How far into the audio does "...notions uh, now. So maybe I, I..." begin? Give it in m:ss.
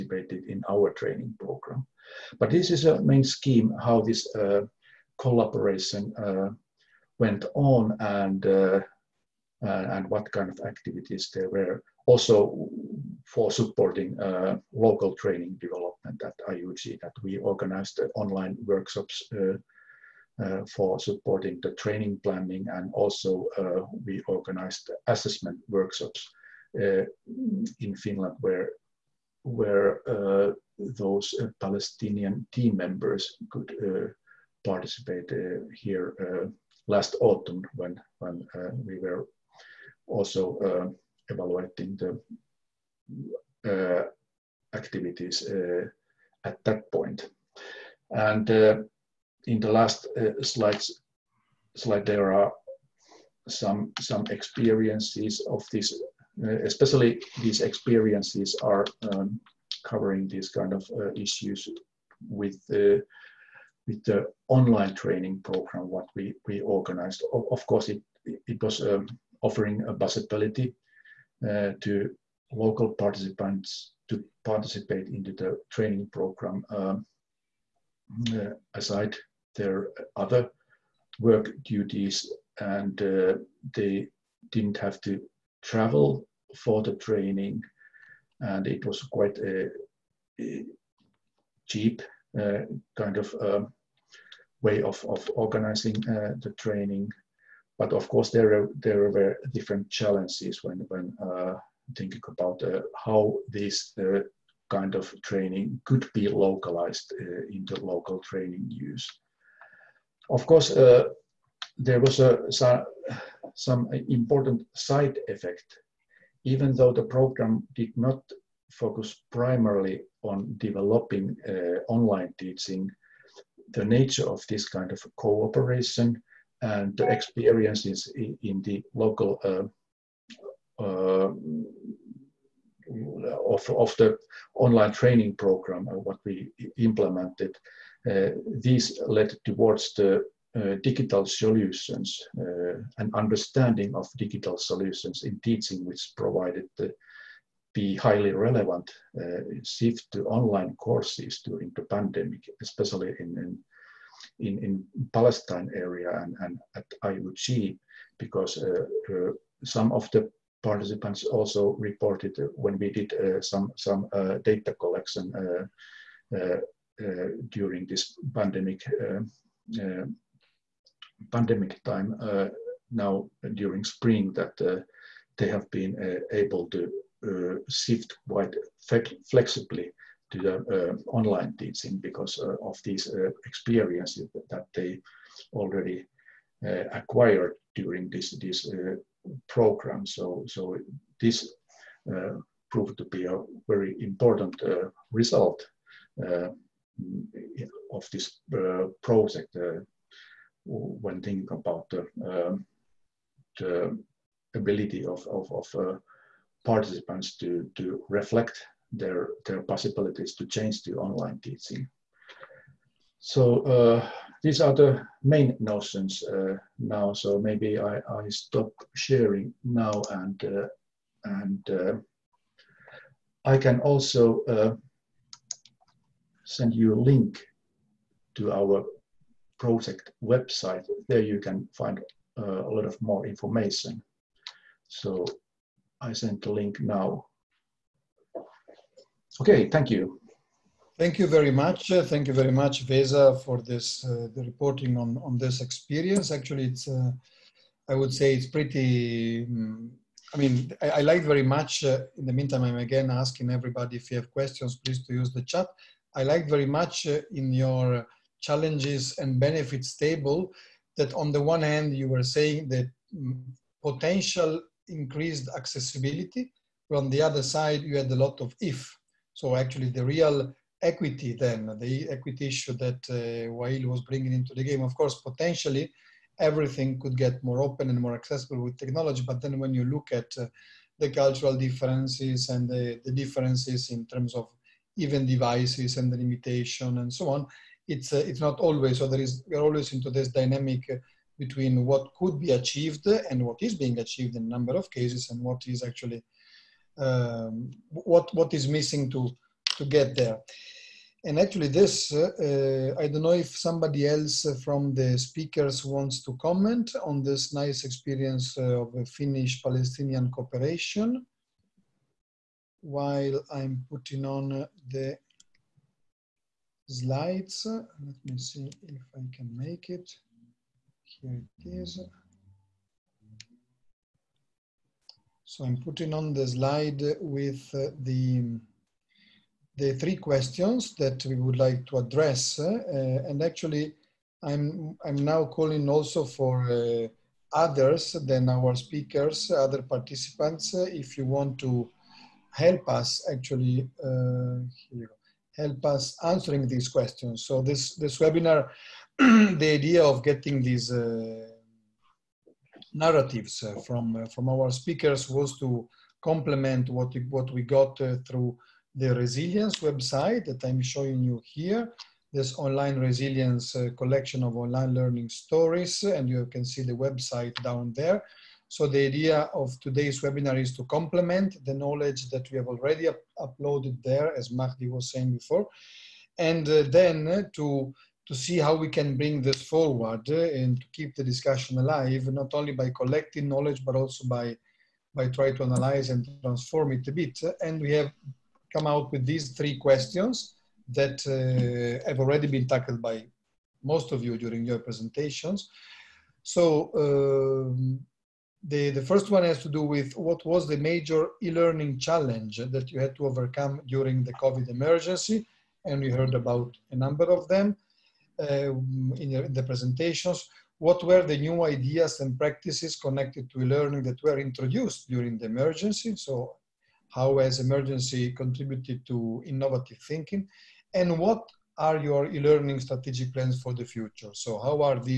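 3:35.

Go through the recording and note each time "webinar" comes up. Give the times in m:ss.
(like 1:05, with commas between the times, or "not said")
5:48, 6:10.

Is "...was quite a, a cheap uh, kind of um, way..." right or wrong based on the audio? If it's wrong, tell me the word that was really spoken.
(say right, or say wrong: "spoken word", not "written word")
right.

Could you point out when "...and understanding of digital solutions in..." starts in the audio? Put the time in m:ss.
2:22.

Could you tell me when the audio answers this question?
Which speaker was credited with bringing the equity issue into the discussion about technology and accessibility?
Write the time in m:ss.
4:33.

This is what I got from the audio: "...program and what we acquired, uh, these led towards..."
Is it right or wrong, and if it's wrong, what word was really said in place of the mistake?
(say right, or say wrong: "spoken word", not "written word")
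wrong: "implemented", not "acquired".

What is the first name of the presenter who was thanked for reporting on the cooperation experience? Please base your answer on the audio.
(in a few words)
Vesa.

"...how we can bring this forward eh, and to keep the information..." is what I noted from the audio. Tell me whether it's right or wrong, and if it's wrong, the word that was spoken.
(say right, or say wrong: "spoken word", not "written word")
wrong: "discussion", not "information".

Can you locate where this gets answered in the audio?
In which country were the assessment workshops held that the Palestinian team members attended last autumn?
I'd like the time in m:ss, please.
0:27.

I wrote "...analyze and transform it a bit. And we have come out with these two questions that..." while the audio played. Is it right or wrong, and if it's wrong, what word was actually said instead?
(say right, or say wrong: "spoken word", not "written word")
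wrong: "three", not "two".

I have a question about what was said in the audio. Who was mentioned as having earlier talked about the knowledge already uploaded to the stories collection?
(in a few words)
Mahdi.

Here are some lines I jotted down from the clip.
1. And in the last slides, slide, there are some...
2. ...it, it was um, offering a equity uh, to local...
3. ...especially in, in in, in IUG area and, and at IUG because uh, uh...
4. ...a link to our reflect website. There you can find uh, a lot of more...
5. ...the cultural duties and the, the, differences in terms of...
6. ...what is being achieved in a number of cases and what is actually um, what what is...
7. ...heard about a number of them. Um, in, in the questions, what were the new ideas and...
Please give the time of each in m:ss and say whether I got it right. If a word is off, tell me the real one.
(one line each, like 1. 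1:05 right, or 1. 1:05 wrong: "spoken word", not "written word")
1. 0:48 right
2. 1:07 wrong: "possibility", not "equity"
3. 2:32 wrong: "Palestine", not "IUG"
4. 3:46 wrong: "project", not "reflect"
5. 4:40 wrong: "differences", not "duties"
6. 4:53 right
7. 6:46 wrong: "presentations", not "questions".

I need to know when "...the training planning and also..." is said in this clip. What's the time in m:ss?
0:21.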